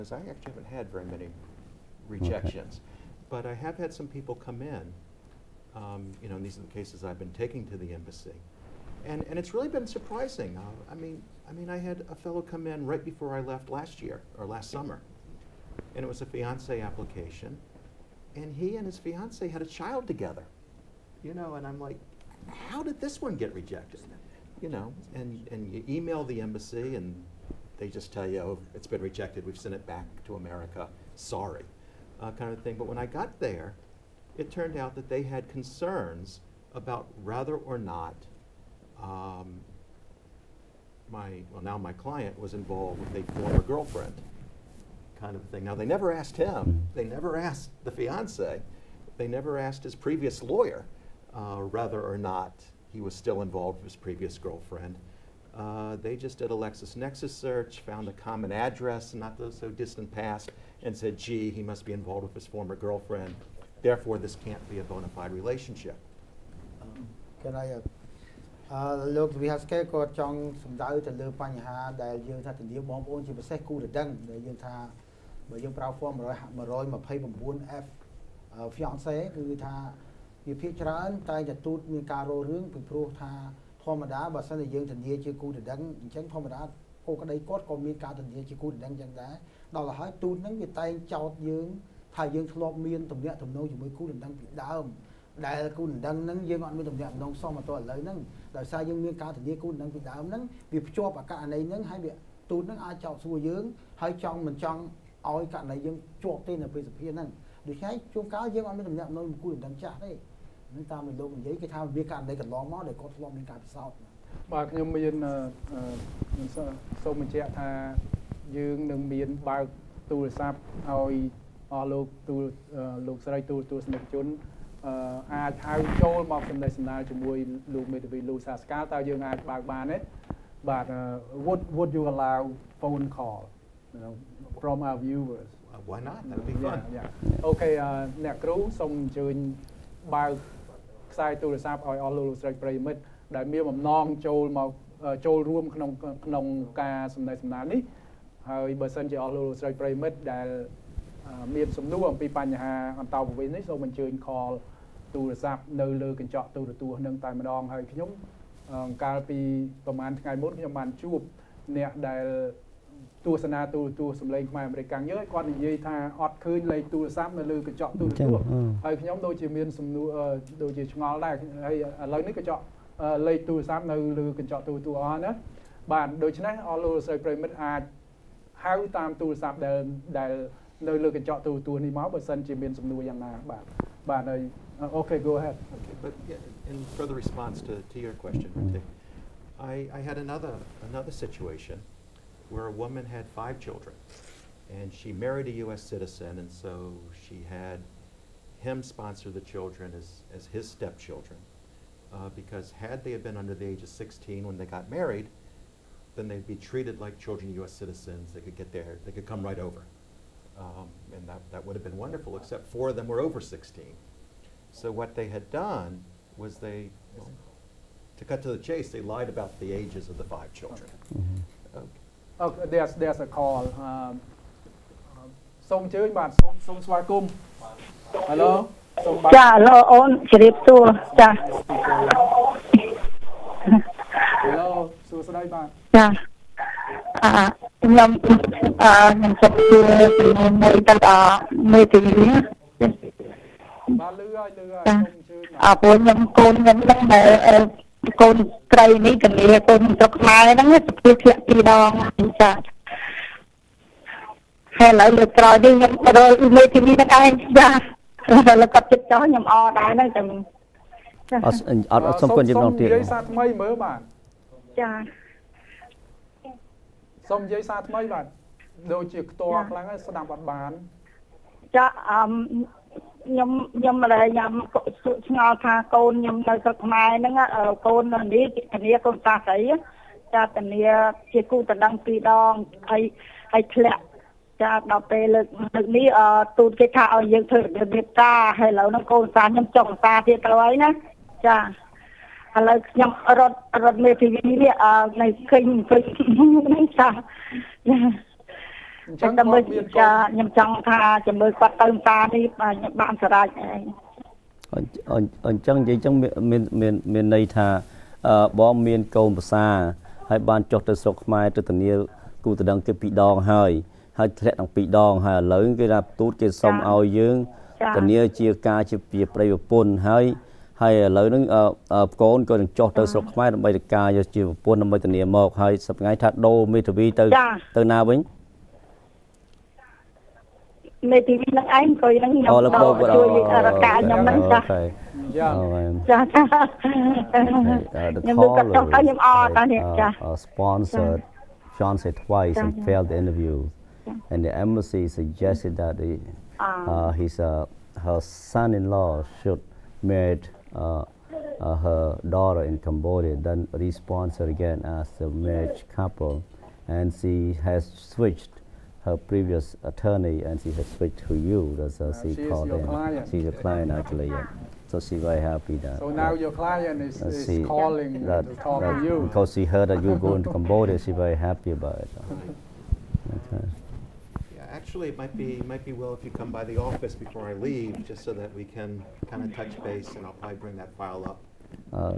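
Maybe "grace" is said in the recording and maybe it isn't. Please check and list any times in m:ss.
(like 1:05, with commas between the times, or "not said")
not said.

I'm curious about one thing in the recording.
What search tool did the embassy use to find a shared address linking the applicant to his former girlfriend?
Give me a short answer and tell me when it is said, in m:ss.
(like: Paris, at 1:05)
LexisNexis, at 0:56.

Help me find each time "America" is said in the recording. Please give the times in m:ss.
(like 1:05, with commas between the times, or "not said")
0:30.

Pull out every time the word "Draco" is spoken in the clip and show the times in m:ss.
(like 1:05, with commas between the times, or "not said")
not said.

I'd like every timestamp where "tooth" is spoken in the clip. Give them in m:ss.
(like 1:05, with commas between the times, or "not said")
1:21.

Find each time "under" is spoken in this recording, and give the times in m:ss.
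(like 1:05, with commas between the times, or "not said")
3:23.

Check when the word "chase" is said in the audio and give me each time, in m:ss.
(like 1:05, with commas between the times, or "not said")
3:38.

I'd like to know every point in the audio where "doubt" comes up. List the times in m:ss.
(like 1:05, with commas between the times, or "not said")
1:10.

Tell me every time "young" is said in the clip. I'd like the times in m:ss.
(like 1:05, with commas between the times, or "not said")
1:14, 1:24, 1:28.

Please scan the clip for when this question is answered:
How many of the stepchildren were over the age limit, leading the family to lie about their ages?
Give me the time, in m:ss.
3:32.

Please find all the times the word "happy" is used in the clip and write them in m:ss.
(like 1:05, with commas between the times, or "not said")
6:05, 6:11.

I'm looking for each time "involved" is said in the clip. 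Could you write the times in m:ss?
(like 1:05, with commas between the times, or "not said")
0:42, 0:53, 1:01.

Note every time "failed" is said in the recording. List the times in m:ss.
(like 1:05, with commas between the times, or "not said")
5:42.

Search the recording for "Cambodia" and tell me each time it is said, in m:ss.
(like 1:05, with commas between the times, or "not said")
5:52, 6:10.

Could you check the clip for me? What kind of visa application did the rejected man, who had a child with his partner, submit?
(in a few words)
Fiance application.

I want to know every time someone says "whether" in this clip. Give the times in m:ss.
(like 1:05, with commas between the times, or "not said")
0:37, 0:51.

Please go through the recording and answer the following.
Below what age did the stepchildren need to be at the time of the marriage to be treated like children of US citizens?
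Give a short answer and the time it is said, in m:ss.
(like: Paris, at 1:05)
16, at 3:23.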